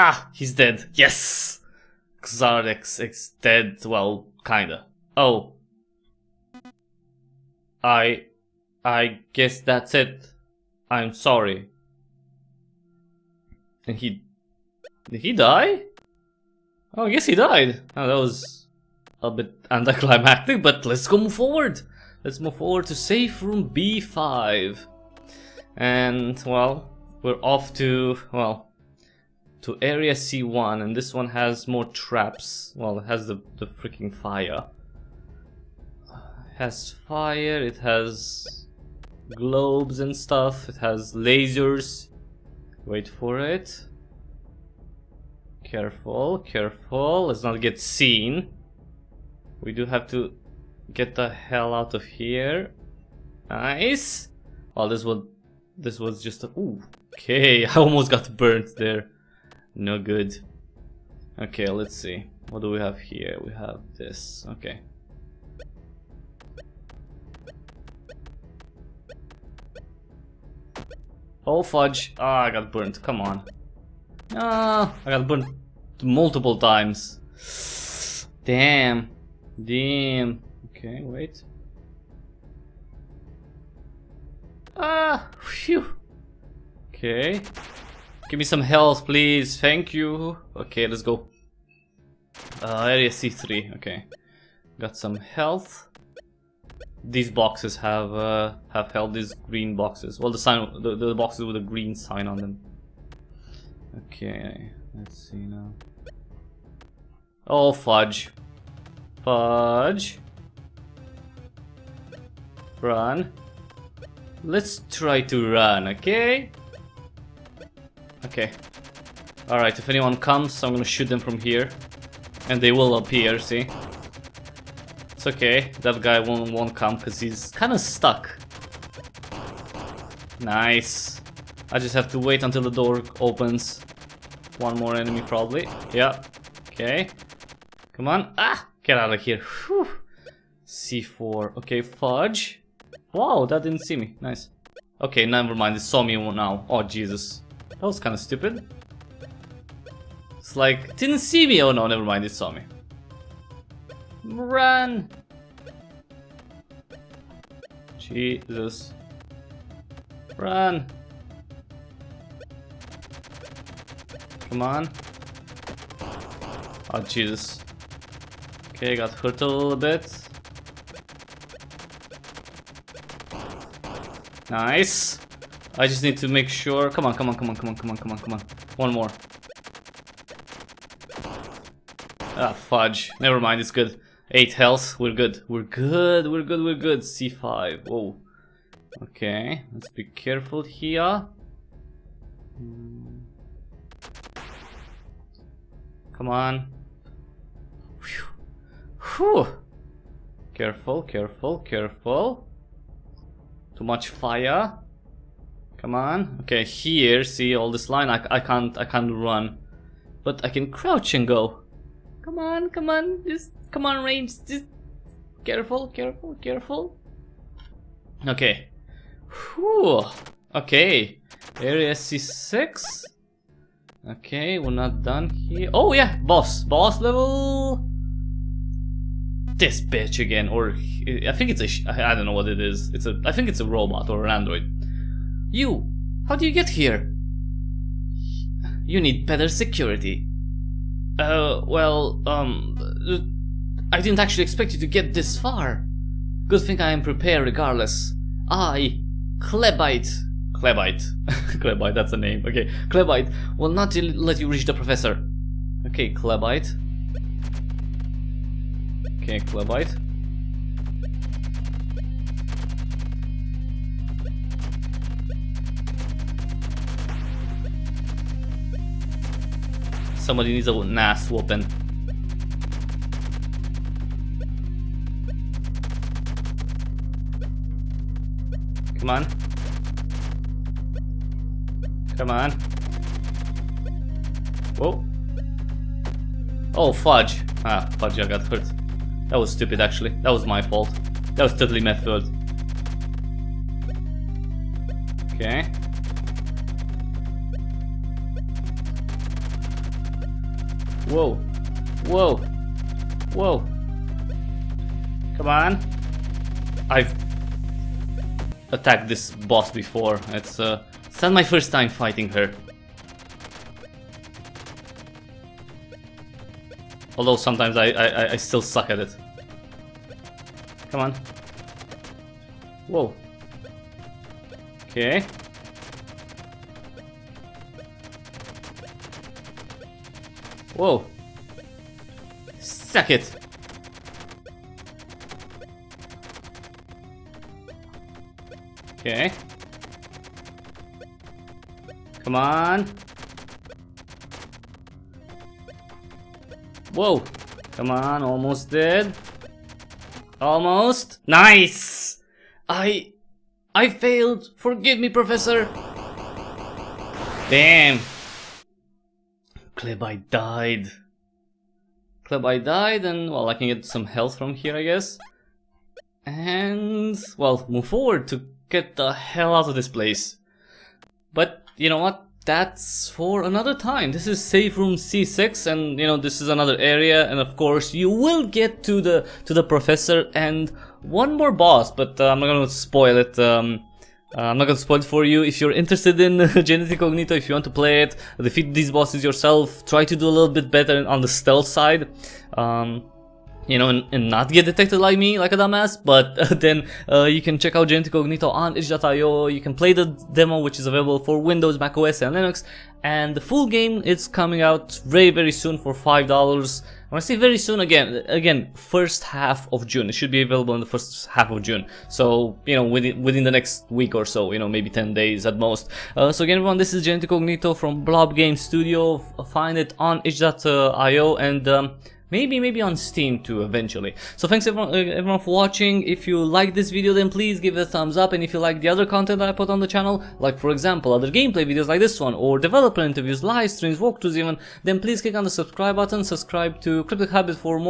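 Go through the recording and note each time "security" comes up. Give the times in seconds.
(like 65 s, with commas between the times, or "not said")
239 s.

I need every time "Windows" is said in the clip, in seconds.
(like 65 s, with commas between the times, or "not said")
401 s.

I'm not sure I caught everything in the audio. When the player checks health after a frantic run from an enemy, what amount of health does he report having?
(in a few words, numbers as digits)
8.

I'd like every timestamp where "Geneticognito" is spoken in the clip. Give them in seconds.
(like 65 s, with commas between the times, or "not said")
386 s, 397 s.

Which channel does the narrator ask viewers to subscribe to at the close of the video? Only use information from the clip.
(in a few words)
Cryptic Hybrid.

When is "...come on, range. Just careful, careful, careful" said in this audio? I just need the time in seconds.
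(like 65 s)
213 s.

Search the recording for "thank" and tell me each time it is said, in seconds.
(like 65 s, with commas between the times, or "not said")
89 s, 424 s.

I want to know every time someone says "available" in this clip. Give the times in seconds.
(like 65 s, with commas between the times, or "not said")
400 s, 410 s.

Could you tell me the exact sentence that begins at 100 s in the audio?
Well, the sign, the, the boxes with a green sign on them.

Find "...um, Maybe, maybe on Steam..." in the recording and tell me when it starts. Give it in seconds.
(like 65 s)
421 s.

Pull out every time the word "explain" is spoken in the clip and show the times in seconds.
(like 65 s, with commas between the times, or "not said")
not said.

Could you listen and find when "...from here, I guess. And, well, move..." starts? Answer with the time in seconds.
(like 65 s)
364 s.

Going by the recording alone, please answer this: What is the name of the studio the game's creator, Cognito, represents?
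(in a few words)
Blob Game Studio.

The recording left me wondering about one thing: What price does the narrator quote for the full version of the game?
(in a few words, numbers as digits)
$5.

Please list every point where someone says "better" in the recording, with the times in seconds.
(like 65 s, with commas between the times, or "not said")
239 s, 390 s.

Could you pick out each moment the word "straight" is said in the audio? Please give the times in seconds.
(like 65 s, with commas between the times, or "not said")
not said.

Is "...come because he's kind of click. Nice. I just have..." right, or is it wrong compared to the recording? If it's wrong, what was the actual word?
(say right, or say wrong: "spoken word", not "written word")
wrong: "stuck", not "click".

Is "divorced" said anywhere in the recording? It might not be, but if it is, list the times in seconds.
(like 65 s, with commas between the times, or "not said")
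not said.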